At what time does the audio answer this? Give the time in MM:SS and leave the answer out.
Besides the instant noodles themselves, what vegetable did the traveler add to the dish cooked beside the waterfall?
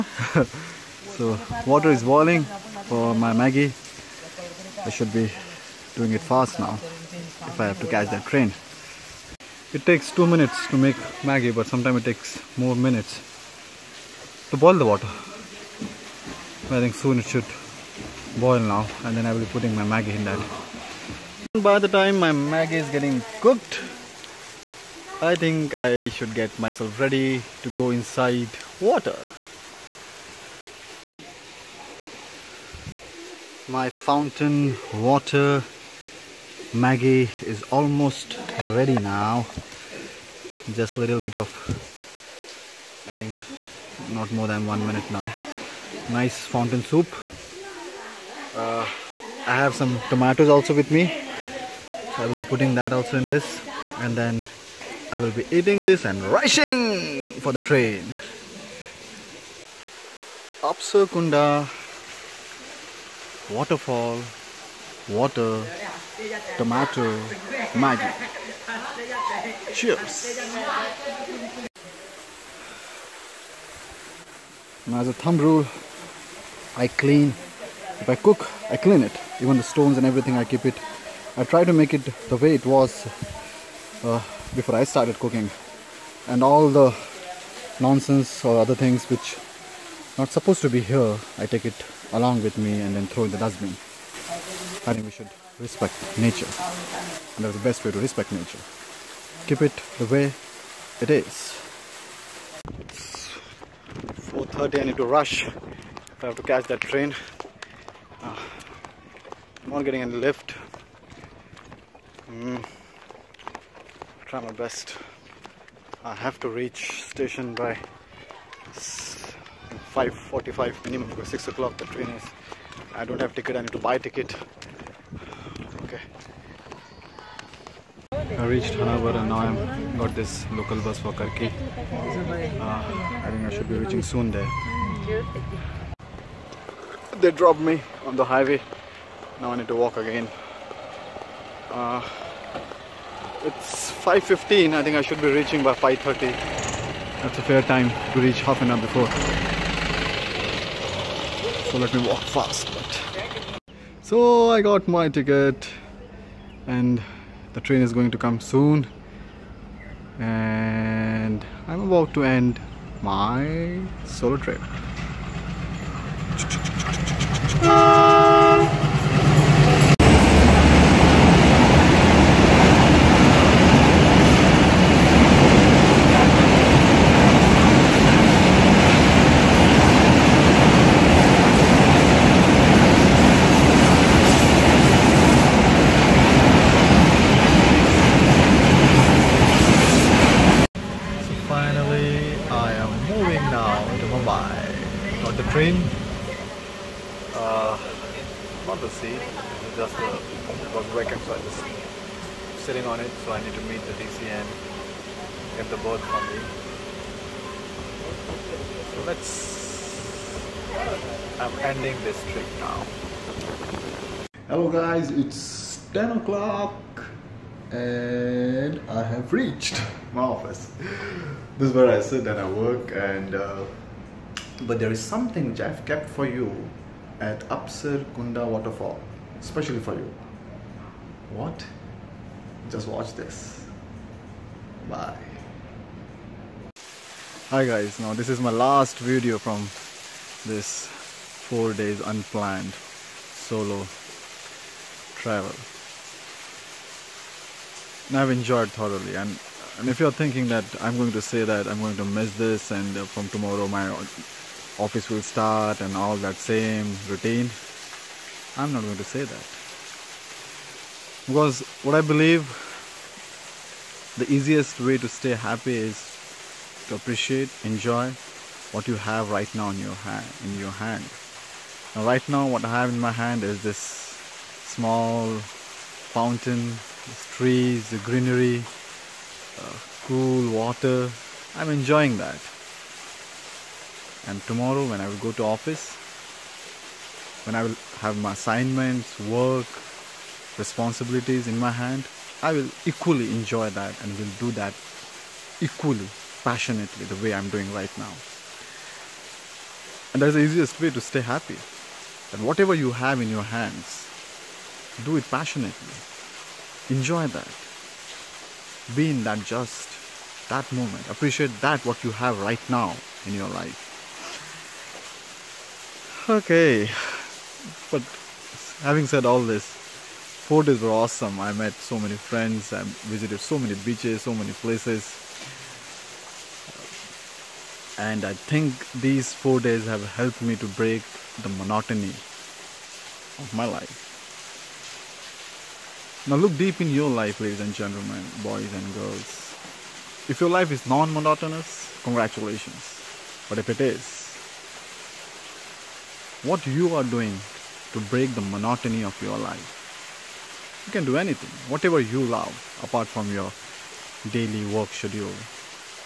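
00:50.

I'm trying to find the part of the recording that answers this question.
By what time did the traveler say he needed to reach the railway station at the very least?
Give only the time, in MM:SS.
01:58.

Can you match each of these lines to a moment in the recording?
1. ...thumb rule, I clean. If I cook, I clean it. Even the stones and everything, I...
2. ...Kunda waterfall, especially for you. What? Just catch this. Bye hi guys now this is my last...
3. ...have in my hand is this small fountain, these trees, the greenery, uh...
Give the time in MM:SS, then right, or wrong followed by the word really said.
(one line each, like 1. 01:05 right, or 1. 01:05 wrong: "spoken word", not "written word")
1. 01:15 right
2. 03:48 wrong: "watch", not "catch"
3. 04:32 right.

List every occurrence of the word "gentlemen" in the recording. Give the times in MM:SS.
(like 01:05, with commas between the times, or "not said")
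05:37.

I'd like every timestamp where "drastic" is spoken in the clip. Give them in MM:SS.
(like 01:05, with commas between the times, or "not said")
not said.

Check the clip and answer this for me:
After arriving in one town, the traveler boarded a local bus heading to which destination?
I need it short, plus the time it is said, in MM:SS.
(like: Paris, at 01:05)
Karki, at 02:11.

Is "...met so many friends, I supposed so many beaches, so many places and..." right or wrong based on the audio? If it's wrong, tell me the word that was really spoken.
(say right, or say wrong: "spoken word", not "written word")
wrong: "visited", not "supposed".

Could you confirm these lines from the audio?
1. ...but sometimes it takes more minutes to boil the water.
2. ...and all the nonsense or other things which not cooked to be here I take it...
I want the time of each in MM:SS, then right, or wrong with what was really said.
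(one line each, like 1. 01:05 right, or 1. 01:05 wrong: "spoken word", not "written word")
1. 00:11 right
2. 01:26 wrong: "supposed", not "cooked".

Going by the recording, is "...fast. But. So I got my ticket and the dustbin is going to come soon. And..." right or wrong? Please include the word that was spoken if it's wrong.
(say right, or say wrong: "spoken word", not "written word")
wrong: "train", not "dustbin".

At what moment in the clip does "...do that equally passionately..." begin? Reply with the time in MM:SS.
04:54.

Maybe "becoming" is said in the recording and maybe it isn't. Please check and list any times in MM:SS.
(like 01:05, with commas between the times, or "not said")
not said.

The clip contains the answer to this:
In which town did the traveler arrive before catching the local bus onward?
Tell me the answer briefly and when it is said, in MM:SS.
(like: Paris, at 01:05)
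Honavar, at 02:08.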